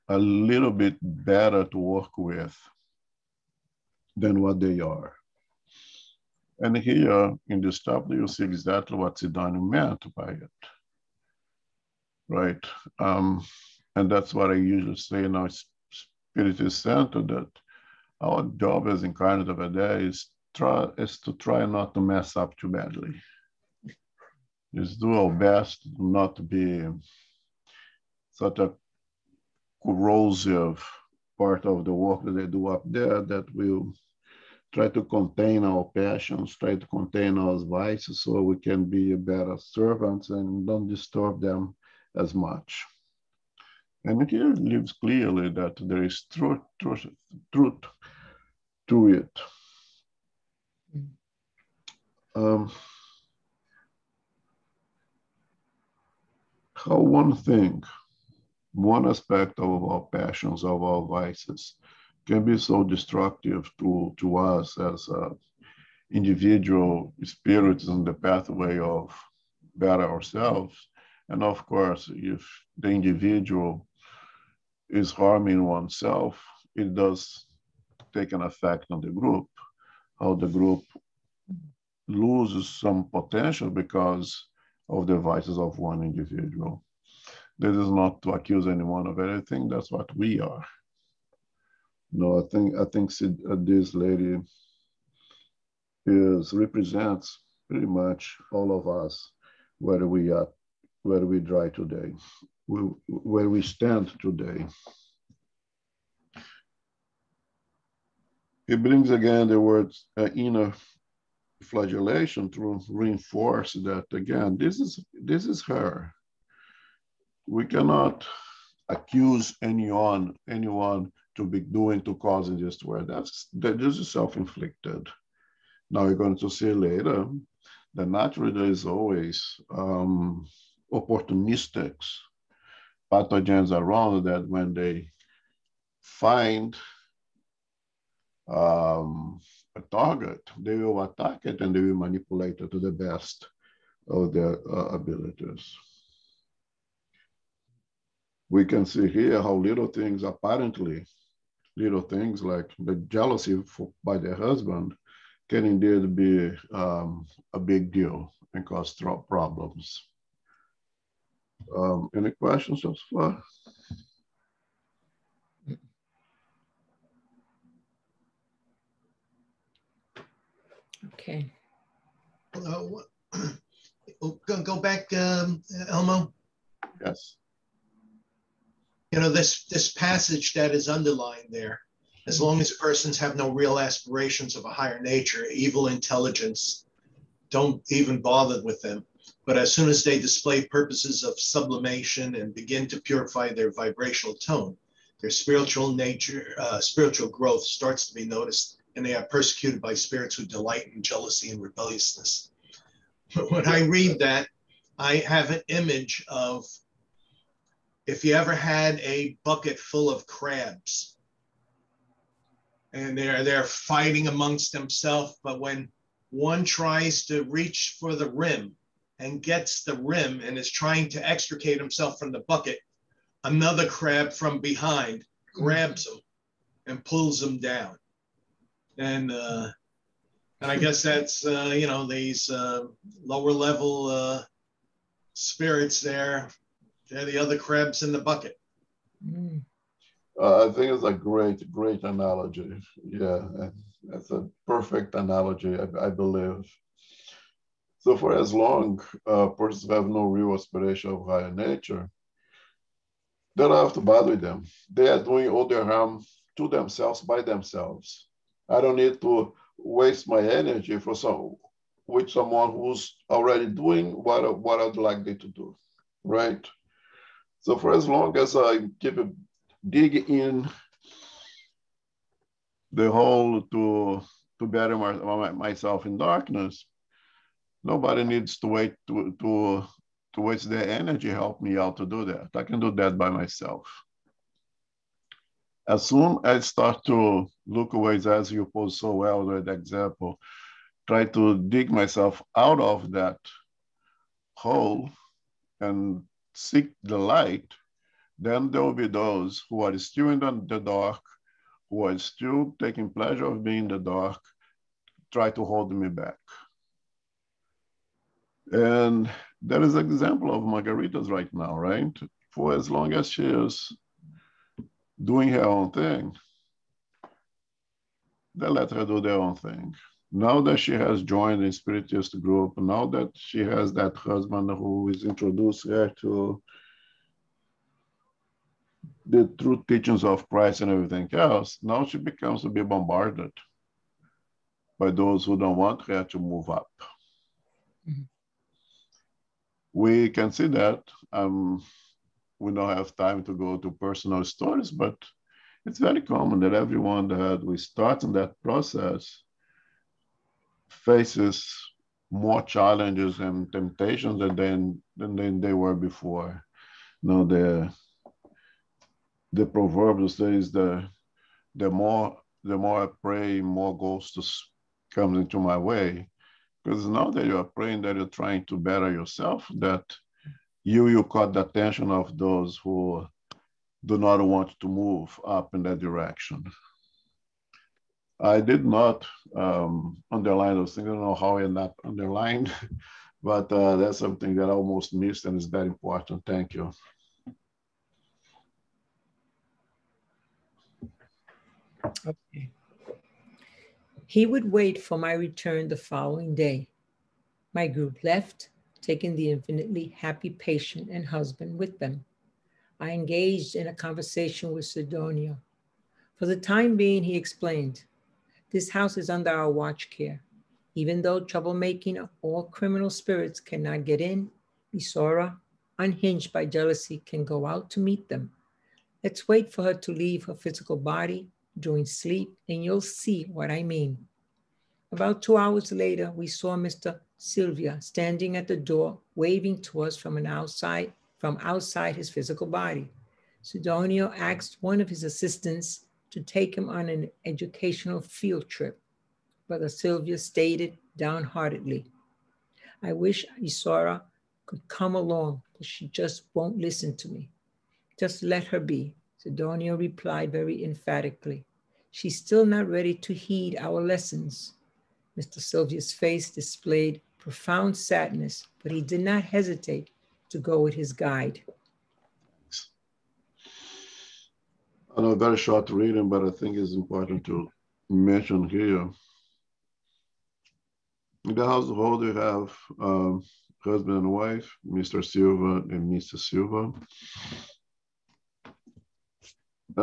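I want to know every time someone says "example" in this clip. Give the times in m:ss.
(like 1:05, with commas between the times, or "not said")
4:49, 5:10.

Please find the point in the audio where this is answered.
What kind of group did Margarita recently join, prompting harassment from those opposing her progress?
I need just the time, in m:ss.
5:21.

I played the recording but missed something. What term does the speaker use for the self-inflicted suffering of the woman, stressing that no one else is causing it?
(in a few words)
Inner flagellation.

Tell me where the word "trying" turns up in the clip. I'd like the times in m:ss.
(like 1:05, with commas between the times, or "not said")
3:40, 6:08.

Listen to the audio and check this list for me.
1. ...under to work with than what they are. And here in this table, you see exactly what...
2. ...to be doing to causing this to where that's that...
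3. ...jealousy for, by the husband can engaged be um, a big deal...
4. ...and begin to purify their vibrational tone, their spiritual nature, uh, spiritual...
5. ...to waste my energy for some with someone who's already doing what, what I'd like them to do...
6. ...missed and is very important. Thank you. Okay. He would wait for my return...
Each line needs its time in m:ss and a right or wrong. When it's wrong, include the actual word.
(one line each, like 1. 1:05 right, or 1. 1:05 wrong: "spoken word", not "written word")
1. 0:01 wrong: "better", not "under"
2. 2:01 right
3. 2:33 wrong: "indeed", not "engaged"
4. 3:12 right
5. 4:19 right
6. 6:25 right.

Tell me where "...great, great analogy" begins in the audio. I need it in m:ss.
4:01.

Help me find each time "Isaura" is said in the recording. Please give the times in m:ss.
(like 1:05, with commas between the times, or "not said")
6:54, 7:23.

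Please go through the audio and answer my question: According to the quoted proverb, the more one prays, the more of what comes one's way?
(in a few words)
Ghosts.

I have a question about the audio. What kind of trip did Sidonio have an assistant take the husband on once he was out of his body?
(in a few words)
An educational field trip.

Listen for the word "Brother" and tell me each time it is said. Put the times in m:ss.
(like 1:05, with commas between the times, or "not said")
7:19.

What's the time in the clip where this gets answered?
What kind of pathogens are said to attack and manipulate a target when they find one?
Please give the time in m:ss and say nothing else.
2:10.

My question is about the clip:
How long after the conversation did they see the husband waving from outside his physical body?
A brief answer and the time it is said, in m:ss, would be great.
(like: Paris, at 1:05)
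About two hours, at 7:05.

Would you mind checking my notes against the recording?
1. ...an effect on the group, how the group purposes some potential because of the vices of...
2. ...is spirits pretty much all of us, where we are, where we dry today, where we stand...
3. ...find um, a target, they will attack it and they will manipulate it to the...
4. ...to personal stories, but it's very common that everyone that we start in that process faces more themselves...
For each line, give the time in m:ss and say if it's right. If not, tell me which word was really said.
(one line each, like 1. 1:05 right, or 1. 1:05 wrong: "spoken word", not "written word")
1. 1:18 wrong: "loses", not "purposes"
2. 1:36 wrong: "represents", not "spirits"
3. 2:16 right
4. 5:43 wrong: "challenges", not "themselves".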